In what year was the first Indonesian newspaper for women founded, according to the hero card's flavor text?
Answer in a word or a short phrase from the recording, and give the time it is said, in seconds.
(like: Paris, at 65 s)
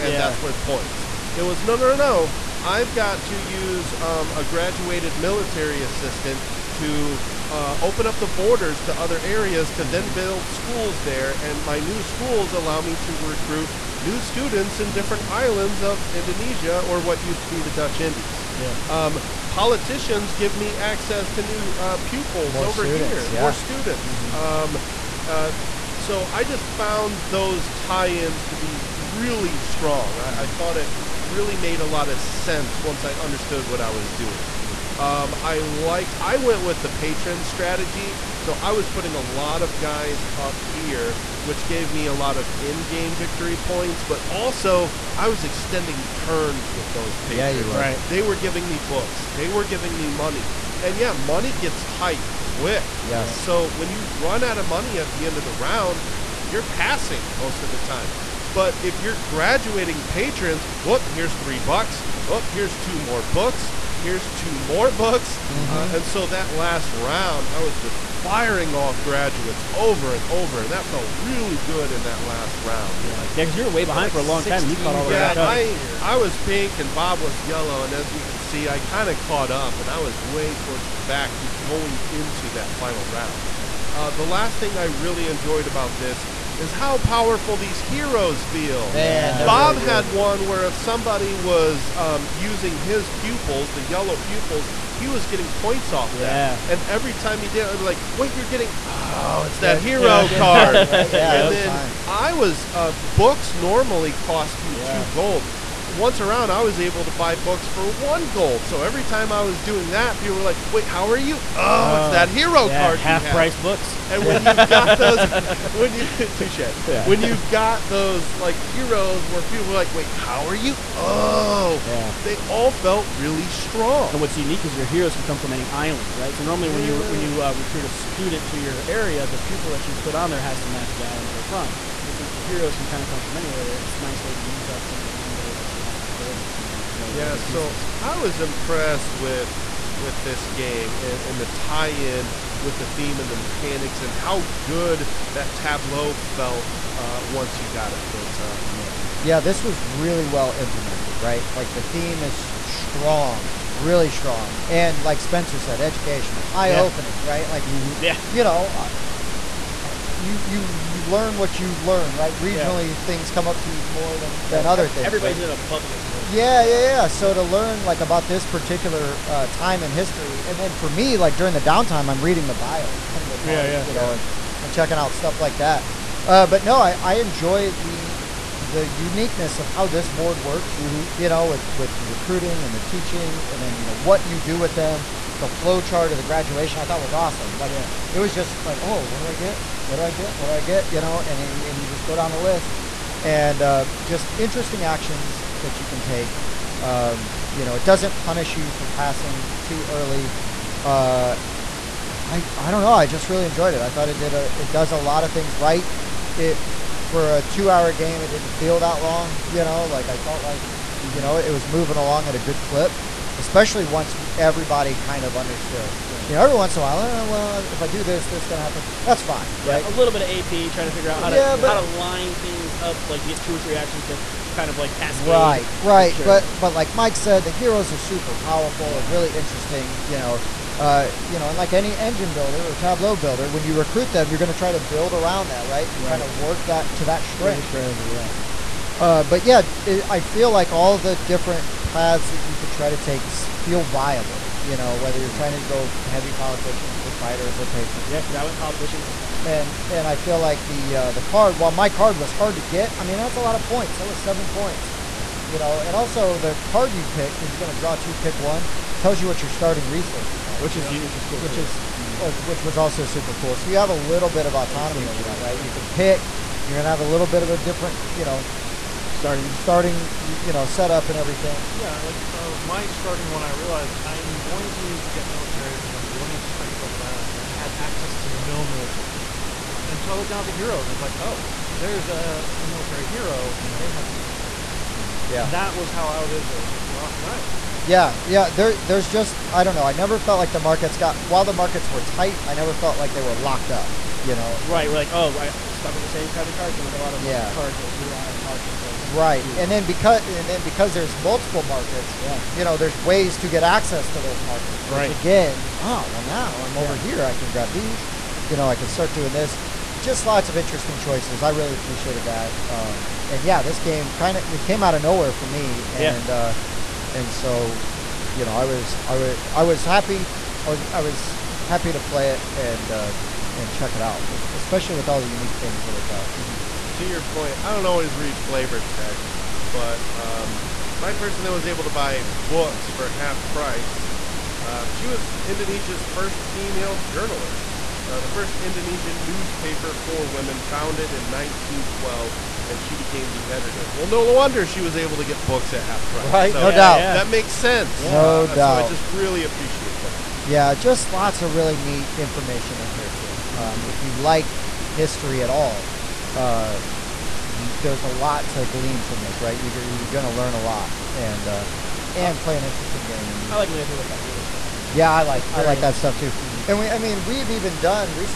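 1912, at 341 s.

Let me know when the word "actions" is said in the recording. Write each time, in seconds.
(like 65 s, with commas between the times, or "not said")
194 s, 223 s.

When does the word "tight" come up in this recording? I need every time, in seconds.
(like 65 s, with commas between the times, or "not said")
51 s, 292 s.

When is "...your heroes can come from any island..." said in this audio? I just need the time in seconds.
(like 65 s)
124 s.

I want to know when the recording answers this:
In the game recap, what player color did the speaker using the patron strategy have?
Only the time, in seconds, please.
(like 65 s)
76 s.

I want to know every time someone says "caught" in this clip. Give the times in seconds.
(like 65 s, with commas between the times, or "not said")
74 s, 79 s.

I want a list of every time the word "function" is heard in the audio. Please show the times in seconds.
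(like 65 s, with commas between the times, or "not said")
not said.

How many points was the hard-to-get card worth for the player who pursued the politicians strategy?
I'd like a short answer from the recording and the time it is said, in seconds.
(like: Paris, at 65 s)
7 points, at 254 s.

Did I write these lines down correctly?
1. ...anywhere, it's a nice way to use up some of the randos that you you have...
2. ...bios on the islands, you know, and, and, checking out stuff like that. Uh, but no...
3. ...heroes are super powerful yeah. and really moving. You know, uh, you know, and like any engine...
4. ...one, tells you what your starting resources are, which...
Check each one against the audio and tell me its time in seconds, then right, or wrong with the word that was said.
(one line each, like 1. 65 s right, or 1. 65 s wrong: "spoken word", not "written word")
1. 133 s right
2. 172 s wrong: "cards", not "islands"
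3. 227 s wrong: "interesting", not "moving"
4. 258 s right.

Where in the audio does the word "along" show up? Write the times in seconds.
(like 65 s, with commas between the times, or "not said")
211 s.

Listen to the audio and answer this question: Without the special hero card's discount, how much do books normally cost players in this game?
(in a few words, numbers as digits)
2 gold.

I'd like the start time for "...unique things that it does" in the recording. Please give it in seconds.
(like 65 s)
325 s.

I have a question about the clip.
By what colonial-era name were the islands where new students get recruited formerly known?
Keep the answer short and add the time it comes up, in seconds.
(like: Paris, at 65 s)
Dutch Indies, at 17 s.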